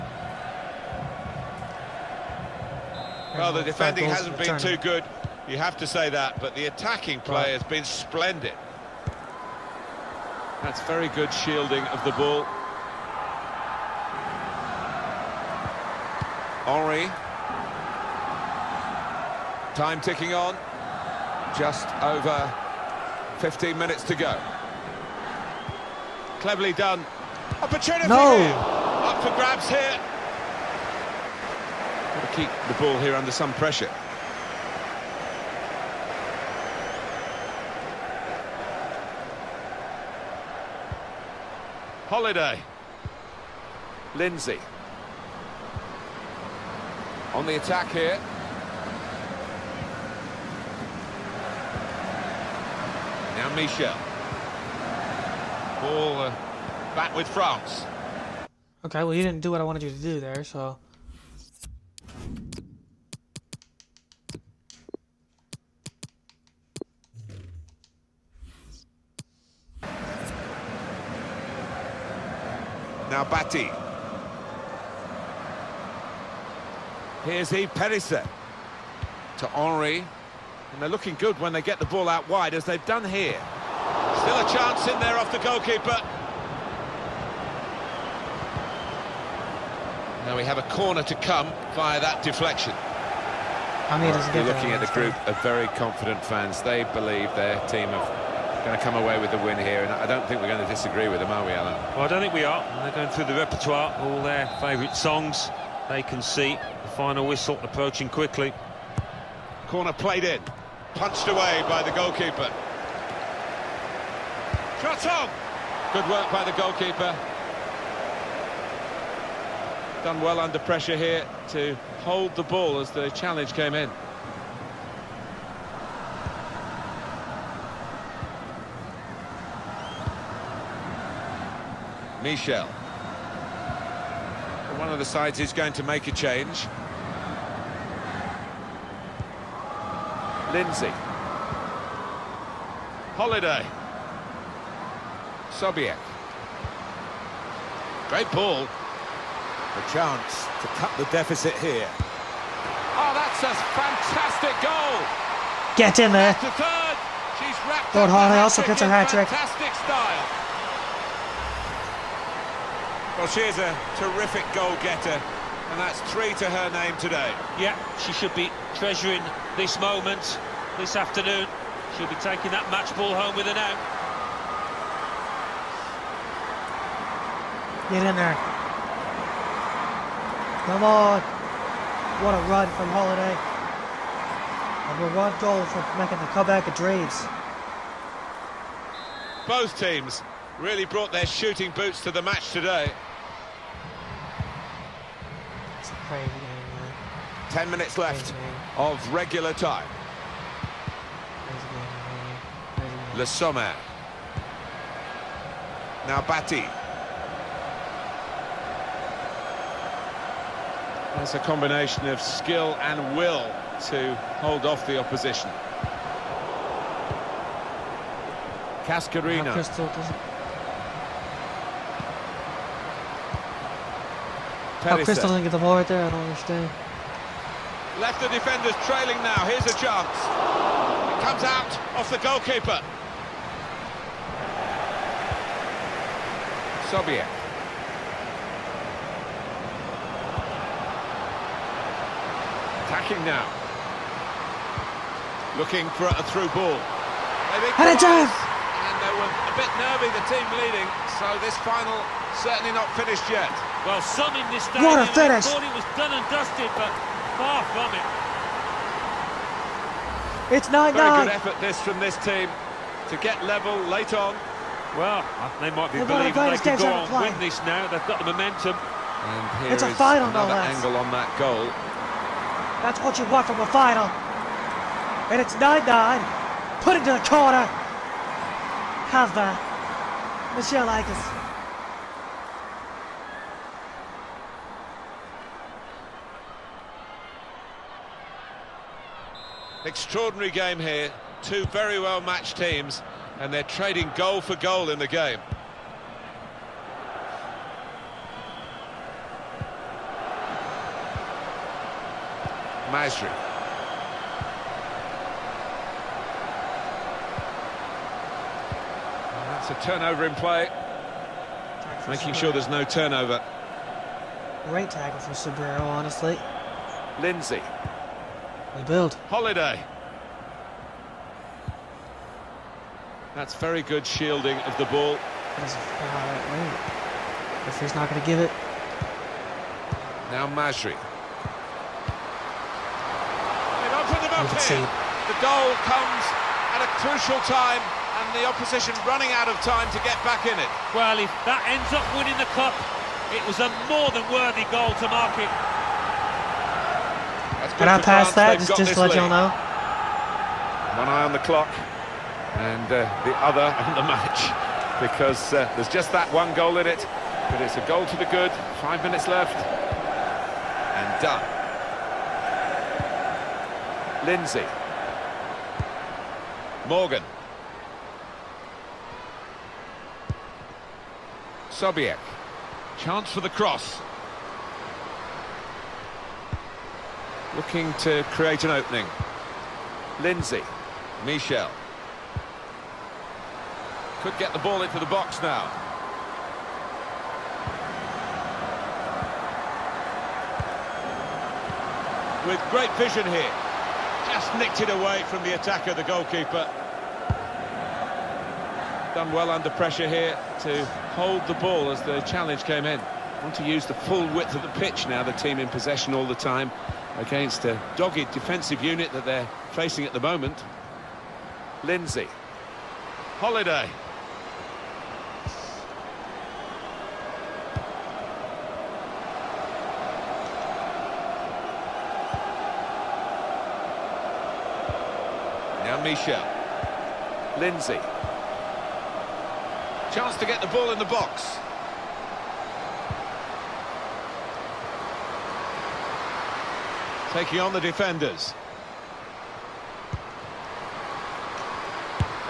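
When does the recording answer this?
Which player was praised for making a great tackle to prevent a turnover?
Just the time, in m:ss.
5:15.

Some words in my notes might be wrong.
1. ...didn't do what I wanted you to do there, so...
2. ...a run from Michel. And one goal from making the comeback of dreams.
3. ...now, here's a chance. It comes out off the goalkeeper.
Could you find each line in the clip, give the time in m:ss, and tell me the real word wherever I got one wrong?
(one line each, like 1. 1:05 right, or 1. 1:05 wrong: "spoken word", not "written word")
1. 0:59 right
2. 3:02 wrong: "Holiday", not "Michel"
3. 3:49 right.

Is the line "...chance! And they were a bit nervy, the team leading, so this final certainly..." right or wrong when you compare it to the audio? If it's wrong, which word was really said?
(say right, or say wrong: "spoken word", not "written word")
right.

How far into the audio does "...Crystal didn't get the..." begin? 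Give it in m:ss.
3:45.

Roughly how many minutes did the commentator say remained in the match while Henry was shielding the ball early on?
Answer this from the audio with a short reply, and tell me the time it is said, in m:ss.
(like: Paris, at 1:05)
15, at 0:21.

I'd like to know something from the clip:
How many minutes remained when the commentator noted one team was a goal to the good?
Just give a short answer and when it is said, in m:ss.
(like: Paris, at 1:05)
5, at 5:58.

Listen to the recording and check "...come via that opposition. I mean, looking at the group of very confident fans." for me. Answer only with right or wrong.
wrong.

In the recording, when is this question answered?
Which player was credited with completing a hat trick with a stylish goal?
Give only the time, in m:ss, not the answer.
2:37.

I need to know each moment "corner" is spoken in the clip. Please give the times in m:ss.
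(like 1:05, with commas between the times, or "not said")
1:30, 1:49, 4:37.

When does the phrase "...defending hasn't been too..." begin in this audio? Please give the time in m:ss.
0:03.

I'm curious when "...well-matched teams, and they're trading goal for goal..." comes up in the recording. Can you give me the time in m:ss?
4:51.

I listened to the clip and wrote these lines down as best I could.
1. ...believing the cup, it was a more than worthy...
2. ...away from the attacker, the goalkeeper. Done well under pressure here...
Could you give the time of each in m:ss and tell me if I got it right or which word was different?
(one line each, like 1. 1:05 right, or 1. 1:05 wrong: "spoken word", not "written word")
1. 5:42 wrong: "winning", not "believing"
2. 6:34 right.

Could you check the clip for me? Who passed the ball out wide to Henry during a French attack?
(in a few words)
Eve Perisset.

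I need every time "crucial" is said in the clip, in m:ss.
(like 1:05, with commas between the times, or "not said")
5:36.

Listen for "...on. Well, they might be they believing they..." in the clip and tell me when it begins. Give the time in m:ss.
4:24.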